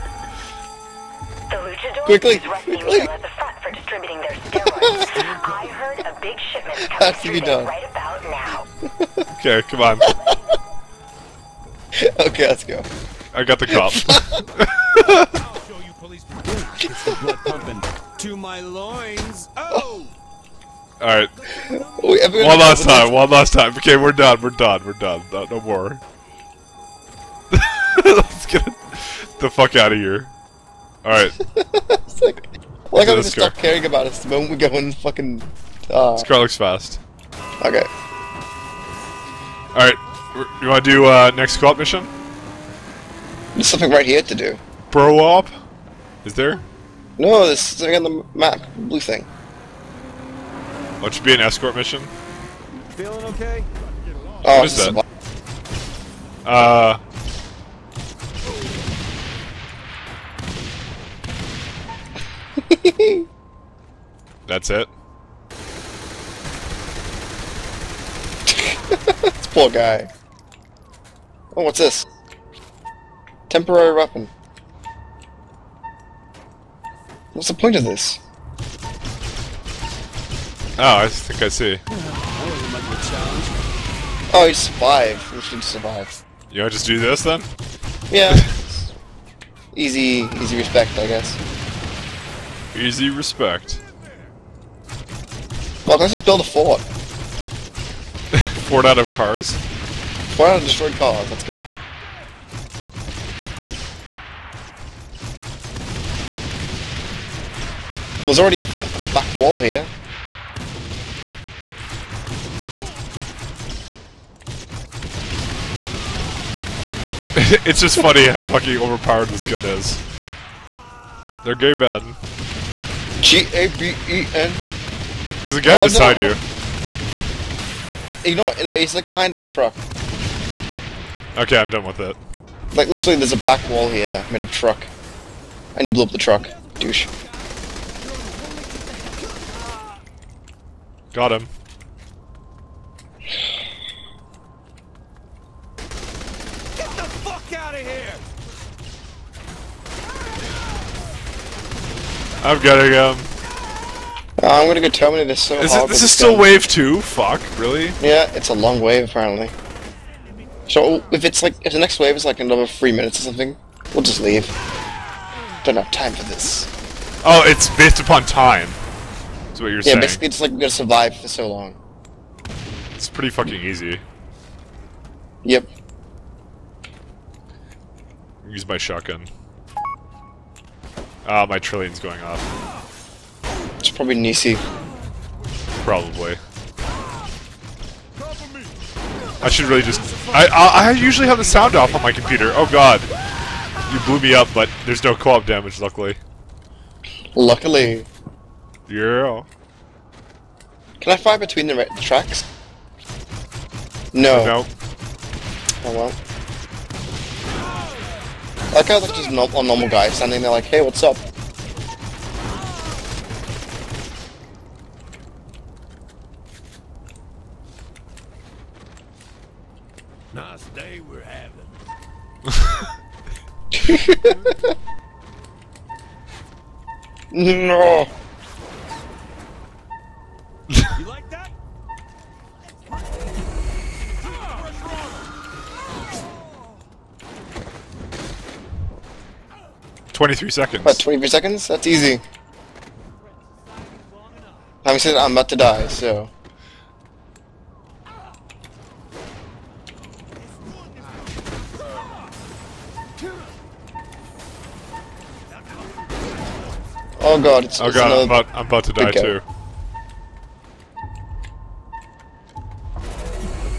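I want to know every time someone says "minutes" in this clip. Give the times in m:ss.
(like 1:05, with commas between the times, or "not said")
2:42.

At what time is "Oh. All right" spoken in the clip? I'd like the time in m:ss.
0:19.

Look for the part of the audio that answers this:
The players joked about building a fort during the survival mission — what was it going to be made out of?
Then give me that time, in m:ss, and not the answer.
1:40.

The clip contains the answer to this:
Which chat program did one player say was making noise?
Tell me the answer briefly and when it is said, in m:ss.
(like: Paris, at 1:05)
Trillian, at 3:01.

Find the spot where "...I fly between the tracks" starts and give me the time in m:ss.
3:21.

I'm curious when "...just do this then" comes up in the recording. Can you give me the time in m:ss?
1:26.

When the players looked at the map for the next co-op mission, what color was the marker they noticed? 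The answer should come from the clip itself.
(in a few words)
Blue.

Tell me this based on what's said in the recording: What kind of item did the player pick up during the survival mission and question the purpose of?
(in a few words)
Temporary weapon.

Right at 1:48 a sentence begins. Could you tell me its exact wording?
there's already a back wall here.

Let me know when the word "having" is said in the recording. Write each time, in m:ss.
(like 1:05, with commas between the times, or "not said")
3:41, 4:04.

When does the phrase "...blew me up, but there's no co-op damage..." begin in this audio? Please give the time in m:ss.
3:14.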